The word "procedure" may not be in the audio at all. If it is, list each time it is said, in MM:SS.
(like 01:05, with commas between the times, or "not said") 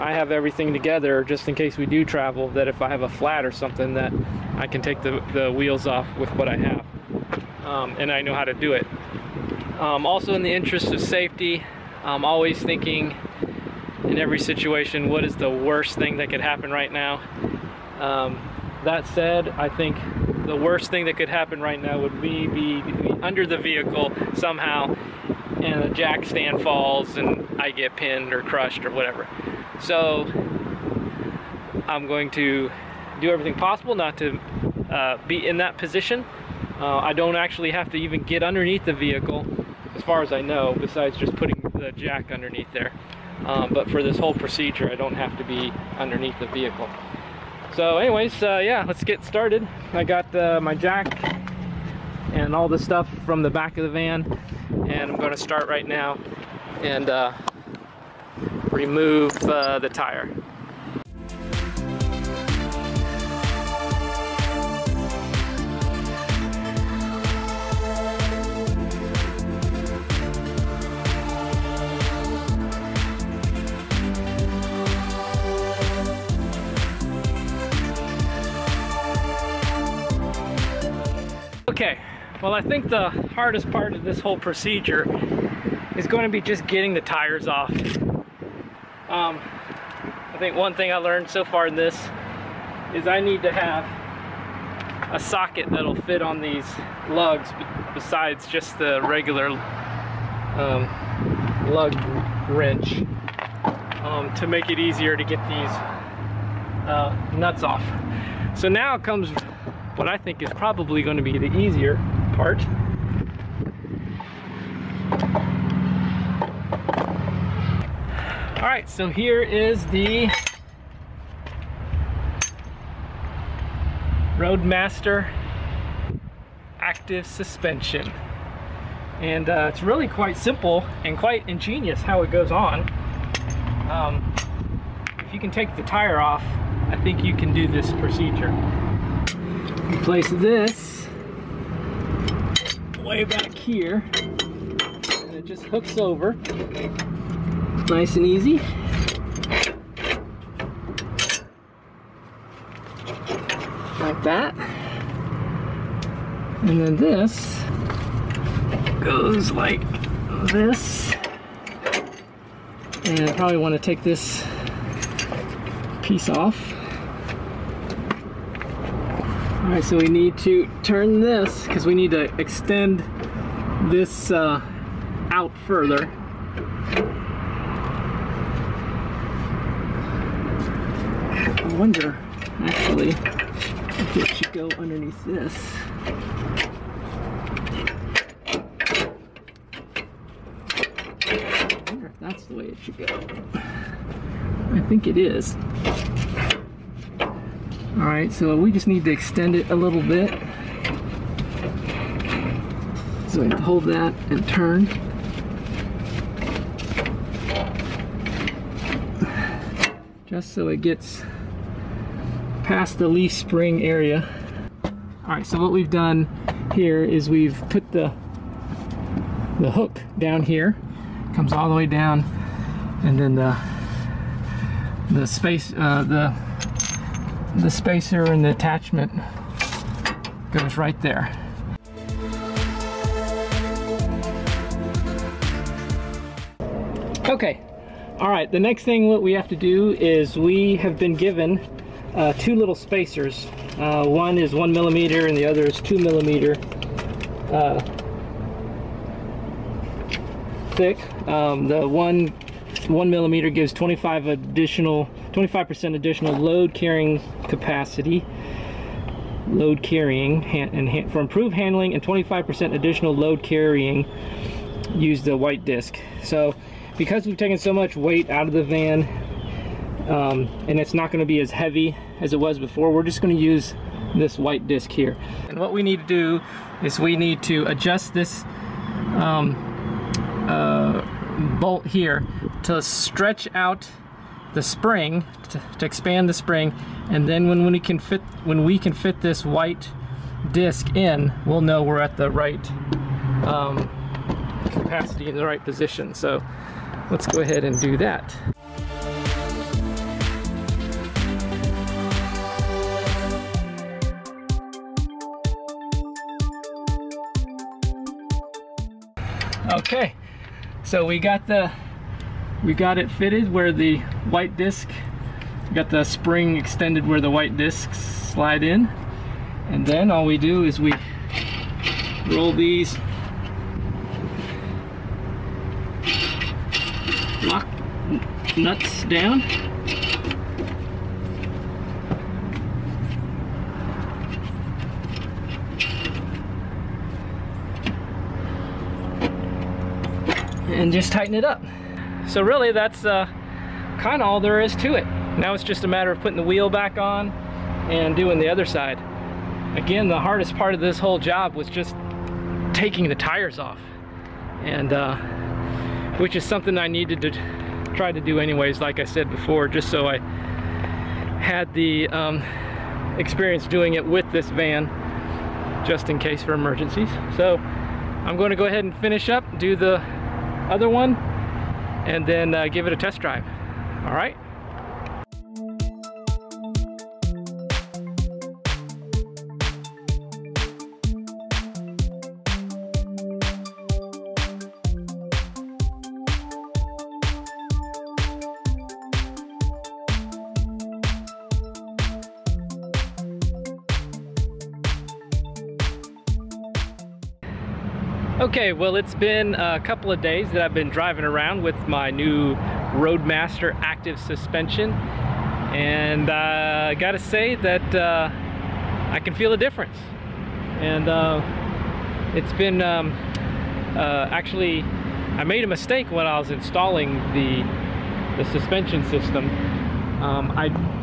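00:44, 01:24, 02:17.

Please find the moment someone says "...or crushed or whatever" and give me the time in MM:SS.
00:28.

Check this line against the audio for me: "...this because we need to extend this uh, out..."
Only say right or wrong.
right.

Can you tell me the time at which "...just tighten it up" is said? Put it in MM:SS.
05:40.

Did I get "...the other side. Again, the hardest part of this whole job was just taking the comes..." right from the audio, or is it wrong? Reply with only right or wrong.
wrong.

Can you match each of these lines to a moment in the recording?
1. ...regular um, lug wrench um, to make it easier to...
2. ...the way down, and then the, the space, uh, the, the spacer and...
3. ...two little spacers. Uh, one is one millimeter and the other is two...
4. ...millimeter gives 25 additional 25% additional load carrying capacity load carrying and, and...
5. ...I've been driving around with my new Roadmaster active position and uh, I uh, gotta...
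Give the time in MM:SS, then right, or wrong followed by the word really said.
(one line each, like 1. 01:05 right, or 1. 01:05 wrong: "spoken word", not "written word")
1. 01:39 right
2. 03:41 right
3. 04:02 right
4. 04:13 right
5. 06:40 wrong: "suspension", not "position".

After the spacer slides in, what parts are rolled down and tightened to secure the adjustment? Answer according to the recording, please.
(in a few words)
Lock nuts.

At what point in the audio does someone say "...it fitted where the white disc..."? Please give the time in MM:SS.
05:12.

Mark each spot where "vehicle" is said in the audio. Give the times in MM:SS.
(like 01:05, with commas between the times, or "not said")
00:23, 00:38, 00:46.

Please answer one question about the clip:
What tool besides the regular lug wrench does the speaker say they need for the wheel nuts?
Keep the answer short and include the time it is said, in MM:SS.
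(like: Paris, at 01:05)
A socket, at 01:35.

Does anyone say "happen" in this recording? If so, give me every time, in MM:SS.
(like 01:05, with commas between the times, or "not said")
00:16, 00:21.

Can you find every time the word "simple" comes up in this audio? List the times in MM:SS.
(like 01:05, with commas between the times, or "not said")
02:10.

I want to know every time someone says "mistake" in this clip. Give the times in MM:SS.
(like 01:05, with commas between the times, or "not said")
06:55.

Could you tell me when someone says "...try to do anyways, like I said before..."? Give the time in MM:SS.
05:57.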